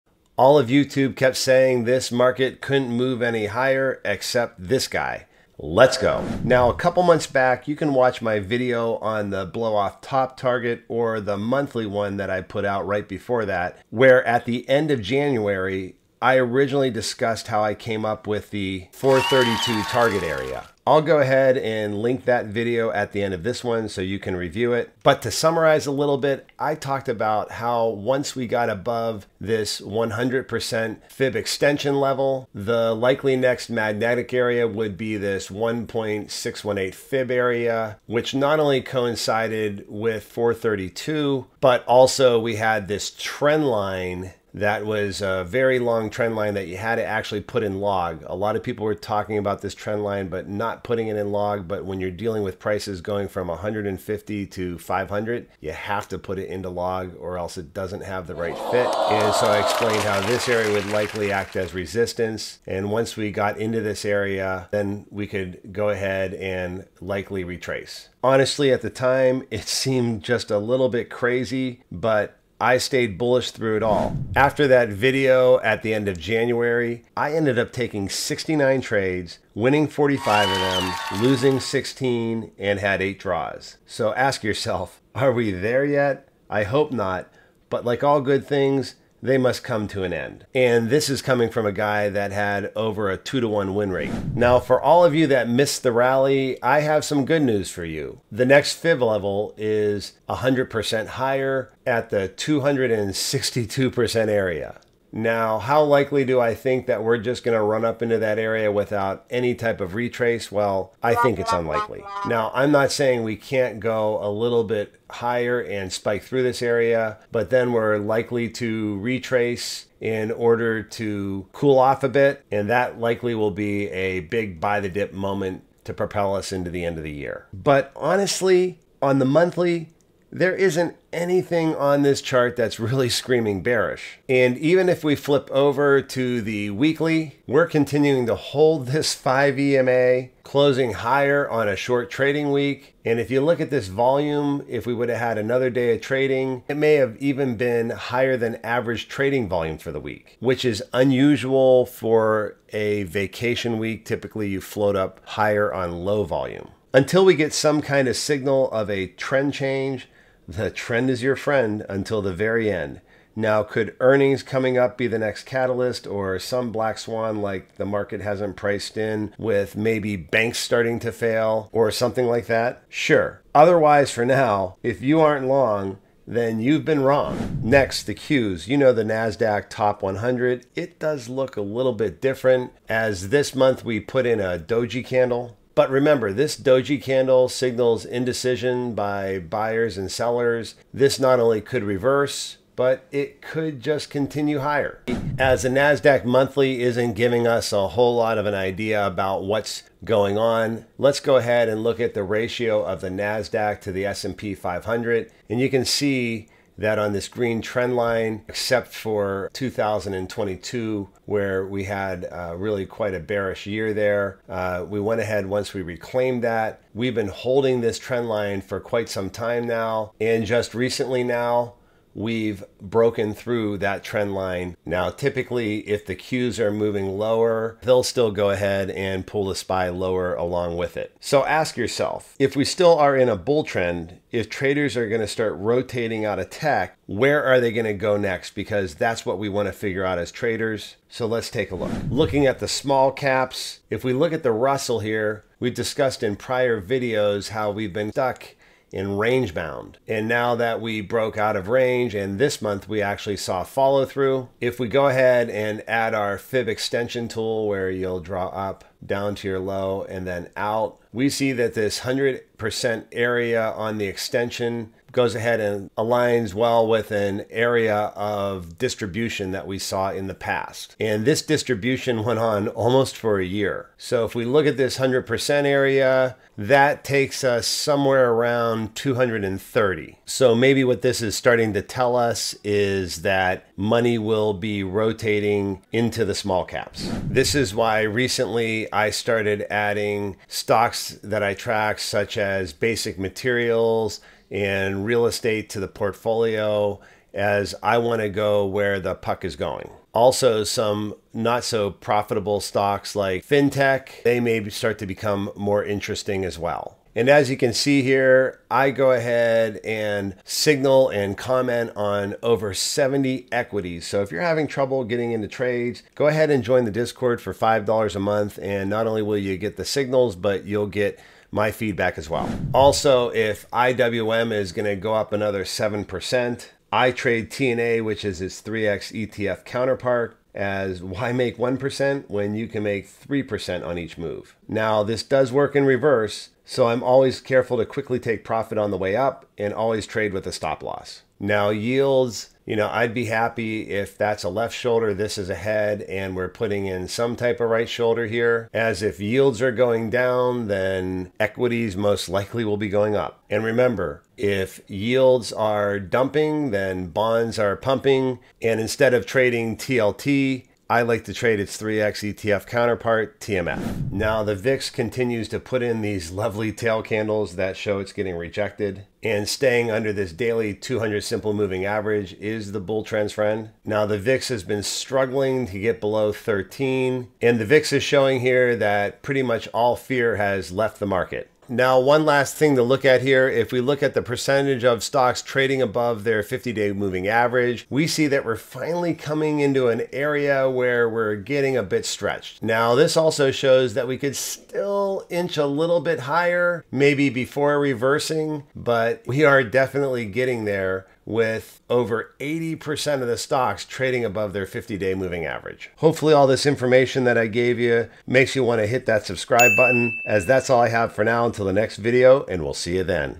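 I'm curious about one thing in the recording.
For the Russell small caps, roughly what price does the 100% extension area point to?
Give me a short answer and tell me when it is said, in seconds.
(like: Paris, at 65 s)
230, at 278 s.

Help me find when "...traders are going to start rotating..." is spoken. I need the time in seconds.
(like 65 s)
234 s.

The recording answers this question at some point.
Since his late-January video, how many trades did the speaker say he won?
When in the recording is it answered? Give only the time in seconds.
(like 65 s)
79 s.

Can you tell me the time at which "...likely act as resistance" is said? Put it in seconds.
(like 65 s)
60 s.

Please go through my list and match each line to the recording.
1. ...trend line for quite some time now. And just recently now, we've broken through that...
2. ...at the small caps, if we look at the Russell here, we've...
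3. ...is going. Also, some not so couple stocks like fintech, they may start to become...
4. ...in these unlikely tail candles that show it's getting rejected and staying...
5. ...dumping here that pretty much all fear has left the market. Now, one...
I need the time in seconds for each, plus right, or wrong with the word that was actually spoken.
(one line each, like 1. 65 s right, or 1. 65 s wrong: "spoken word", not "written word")
1. 217 s right
2. 242 s right
3. 299 s wrong: "profitable", not "couple"
4. 365 s wrong: "lovely", not "unlikely"
5. 378 s wrong: "showing", not "dumping".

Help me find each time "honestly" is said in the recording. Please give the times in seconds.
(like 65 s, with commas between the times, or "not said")
68 s, 127 s.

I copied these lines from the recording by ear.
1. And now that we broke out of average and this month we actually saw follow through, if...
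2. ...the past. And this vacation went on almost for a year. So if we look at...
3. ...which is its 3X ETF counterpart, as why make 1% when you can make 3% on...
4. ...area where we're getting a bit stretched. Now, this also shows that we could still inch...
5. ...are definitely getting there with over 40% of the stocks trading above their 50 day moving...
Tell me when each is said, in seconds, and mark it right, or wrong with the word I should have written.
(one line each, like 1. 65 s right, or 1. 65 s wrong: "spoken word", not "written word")
1. 250 s wrong: "range", not "average"
2. 270 s wrong: "distribution", not "vacation"
3. 328 s right
4. 390 s right
5. 399 s wrong: "80", not "40".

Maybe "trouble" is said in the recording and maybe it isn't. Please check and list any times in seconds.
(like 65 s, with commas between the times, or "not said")
314 s.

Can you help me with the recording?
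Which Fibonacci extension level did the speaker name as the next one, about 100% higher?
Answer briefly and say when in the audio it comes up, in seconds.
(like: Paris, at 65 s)
262%, at 102 s.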